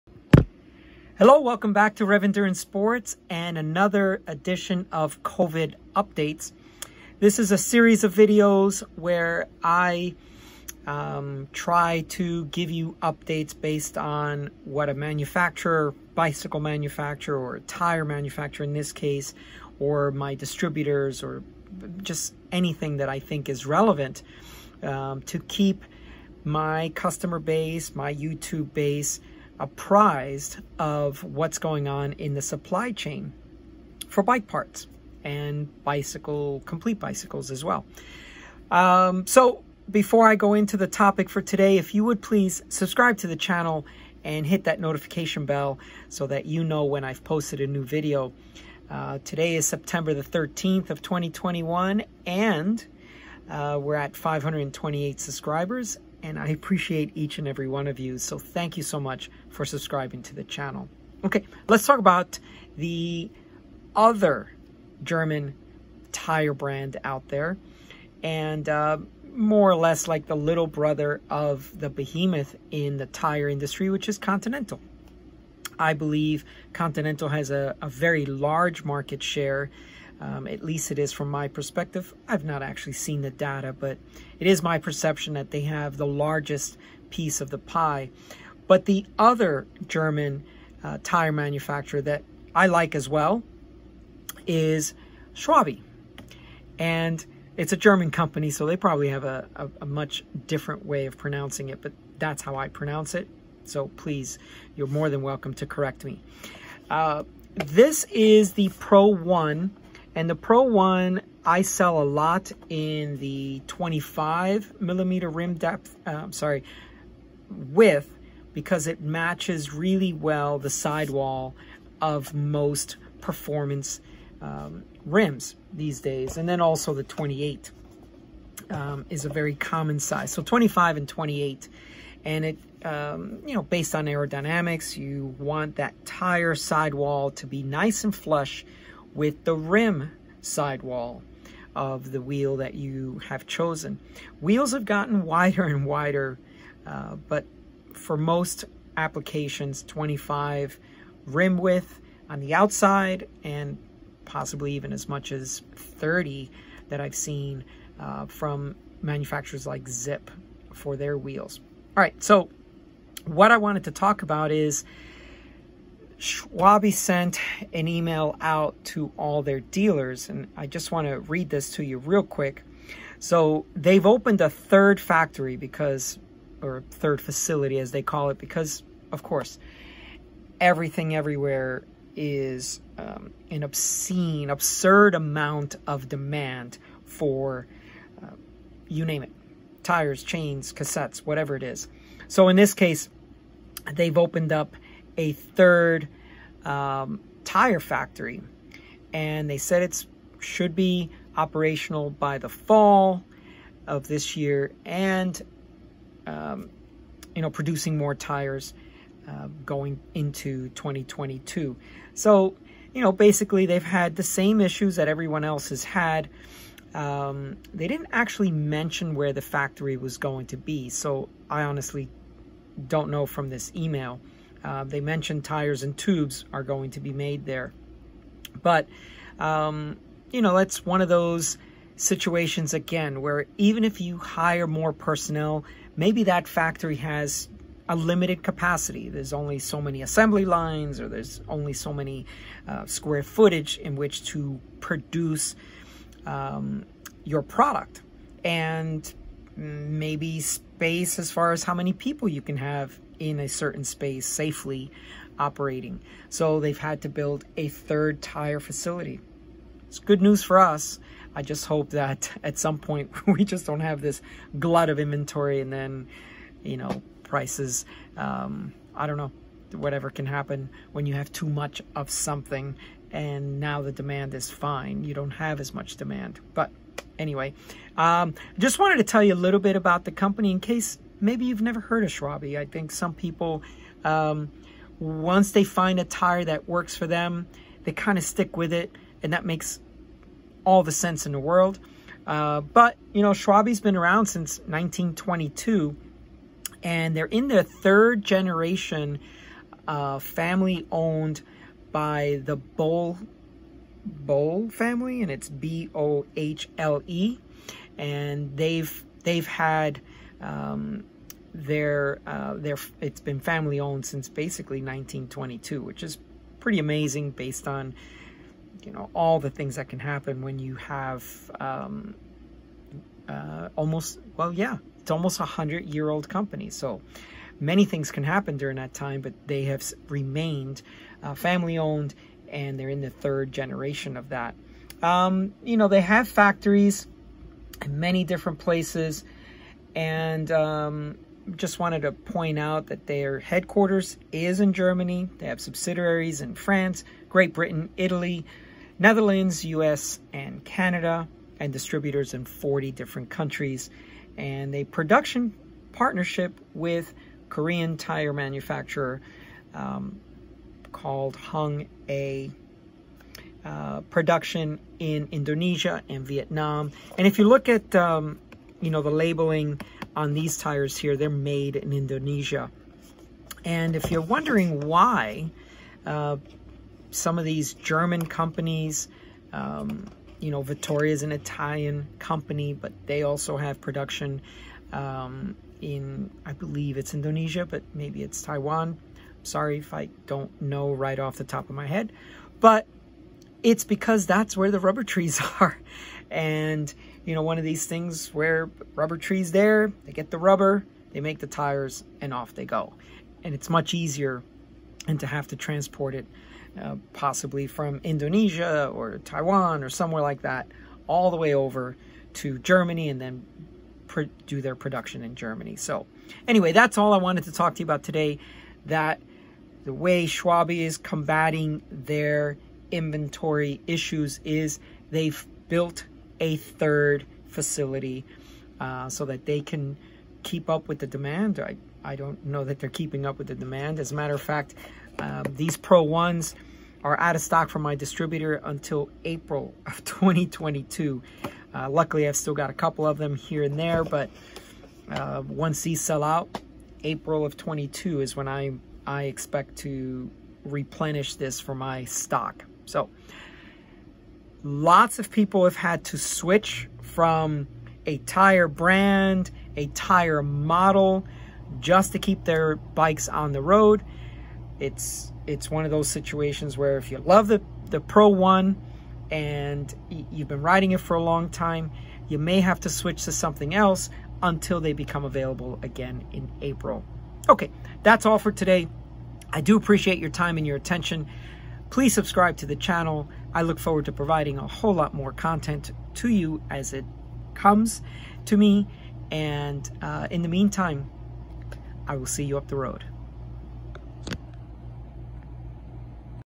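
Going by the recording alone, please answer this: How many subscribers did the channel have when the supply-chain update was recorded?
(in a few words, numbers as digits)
528.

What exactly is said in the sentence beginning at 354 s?
And a production partnership with Korean tire manufacturer um, called Hung A uh, production in Indonesia and Vietnam.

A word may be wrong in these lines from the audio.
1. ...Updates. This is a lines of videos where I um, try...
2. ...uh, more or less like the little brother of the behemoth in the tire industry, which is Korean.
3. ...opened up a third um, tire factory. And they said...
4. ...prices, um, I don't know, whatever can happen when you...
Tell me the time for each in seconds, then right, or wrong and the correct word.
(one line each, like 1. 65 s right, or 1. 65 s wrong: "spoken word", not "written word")
1. 5 s wrong: "series", not "lines"
2. 68 s wrong: "Continental", not "Korean"
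3. 194 s right
4. 267 s right.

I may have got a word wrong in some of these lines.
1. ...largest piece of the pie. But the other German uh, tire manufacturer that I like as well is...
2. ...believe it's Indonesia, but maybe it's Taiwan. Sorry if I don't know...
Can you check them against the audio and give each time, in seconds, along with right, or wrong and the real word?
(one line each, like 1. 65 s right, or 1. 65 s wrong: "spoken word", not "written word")
1. 86 s right
2. 386 s right.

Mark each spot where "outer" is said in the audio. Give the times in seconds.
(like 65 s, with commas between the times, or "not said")
not said.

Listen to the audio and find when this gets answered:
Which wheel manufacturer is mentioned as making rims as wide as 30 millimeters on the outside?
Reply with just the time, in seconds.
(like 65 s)
159 s.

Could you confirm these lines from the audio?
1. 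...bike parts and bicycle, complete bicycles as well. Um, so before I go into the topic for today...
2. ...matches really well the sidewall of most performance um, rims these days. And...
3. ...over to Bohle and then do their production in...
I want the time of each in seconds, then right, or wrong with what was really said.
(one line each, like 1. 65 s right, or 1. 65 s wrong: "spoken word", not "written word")
1. 34 s right
2. 119 s right
3. 411 s wrong: "Germany", not "Bohle".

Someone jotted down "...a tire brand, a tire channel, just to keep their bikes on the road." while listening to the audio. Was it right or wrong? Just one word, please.
wrong.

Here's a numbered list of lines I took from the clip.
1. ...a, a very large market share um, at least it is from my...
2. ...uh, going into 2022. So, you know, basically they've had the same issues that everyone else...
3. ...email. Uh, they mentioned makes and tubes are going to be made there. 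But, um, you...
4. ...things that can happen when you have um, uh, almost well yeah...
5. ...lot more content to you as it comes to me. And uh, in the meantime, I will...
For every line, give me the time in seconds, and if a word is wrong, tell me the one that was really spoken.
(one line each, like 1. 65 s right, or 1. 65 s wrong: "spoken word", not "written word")
1. 77 s right
2. 209 s right
3. 223 s wrong: "tires", not "makes"
4. 319 s right
5. 484 s right.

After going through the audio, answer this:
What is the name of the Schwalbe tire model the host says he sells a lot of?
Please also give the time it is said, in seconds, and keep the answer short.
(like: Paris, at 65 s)
Pro One, at 110 s.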